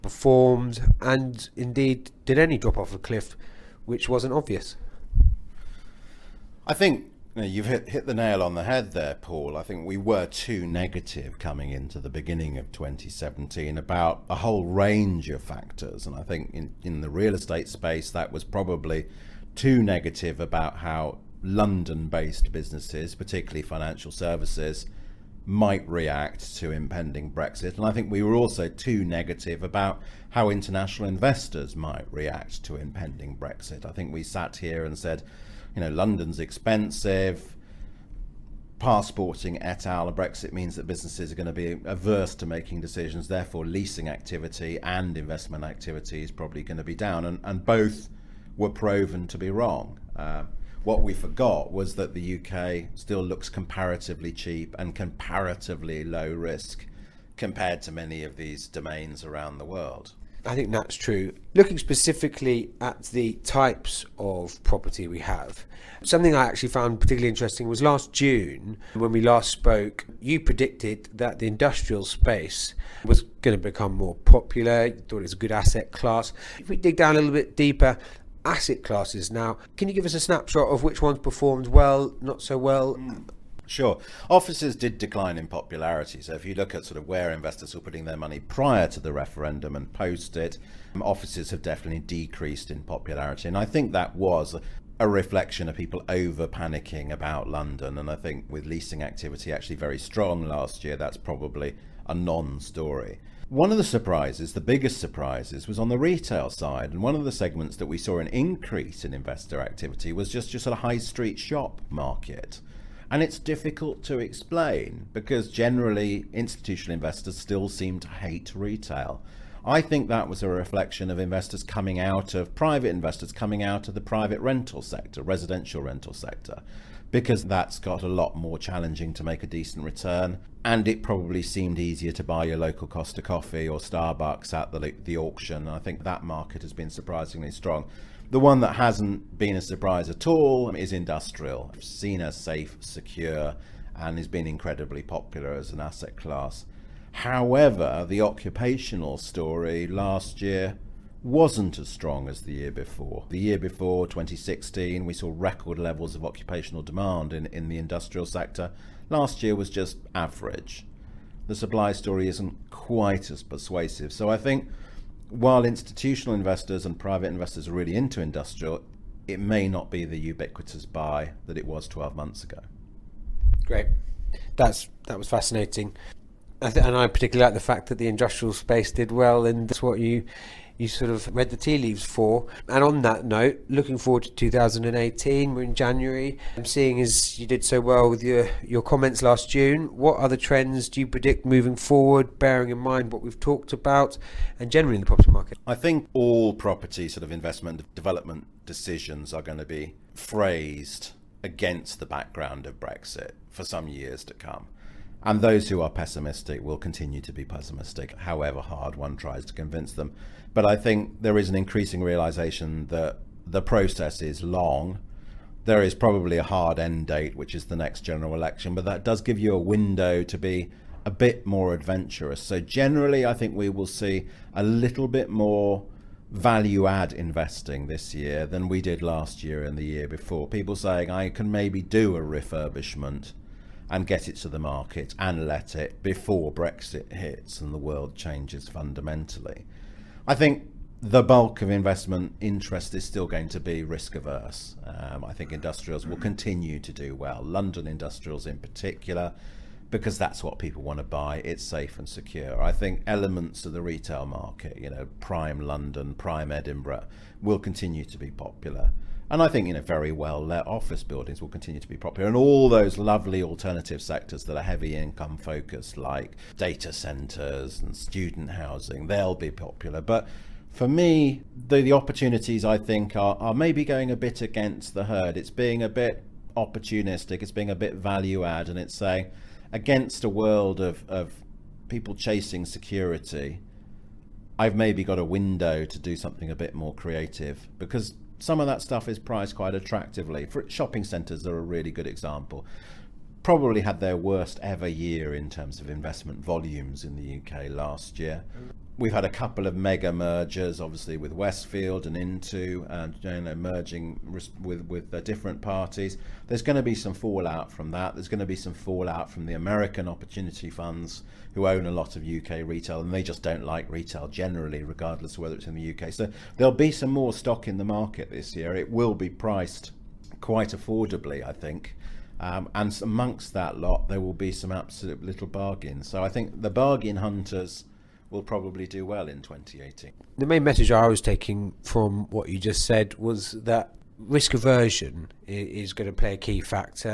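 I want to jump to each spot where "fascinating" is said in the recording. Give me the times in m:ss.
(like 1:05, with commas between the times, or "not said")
2:55.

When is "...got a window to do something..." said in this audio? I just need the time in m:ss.
4:45.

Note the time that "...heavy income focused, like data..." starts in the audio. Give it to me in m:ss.
4:24.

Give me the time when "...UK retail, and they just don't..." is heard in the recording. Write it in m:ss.
5:12.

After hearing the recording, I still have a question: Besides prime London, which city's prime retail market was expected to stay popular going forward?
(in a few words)
Edinburgh.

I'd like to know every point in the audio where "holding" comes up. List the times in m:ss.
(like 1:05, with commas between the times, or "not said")
not said.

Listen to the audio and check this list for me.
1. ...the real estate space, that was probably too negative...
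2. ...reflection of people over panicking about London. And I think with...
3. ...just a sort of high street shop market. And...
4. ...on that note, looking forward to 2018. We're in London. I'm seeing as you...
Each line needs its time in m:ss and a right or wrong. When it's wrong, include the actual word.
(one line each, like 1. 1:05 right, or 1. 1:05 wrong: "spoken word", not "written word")
1. 0:16 right
2. 1:35 right
3. 1:50 right
4. 3:02 wrong: "January", not "London".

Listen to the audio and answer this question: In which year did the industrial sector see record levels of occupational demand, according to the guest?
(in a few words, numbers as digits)
2016.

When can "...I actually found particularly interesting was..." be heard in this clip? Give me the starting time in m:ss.
1:06.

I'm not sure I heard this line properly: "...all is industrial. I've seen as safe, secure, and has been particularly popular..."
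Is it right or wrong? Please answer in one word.
wrong.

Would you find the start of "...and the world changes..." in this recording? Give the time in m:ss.
3:57.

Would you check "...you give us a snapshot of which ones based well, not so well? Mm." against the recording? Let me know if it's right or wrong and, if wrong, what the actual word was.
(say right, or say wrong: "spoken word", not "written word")
wrong: "performed", not "based".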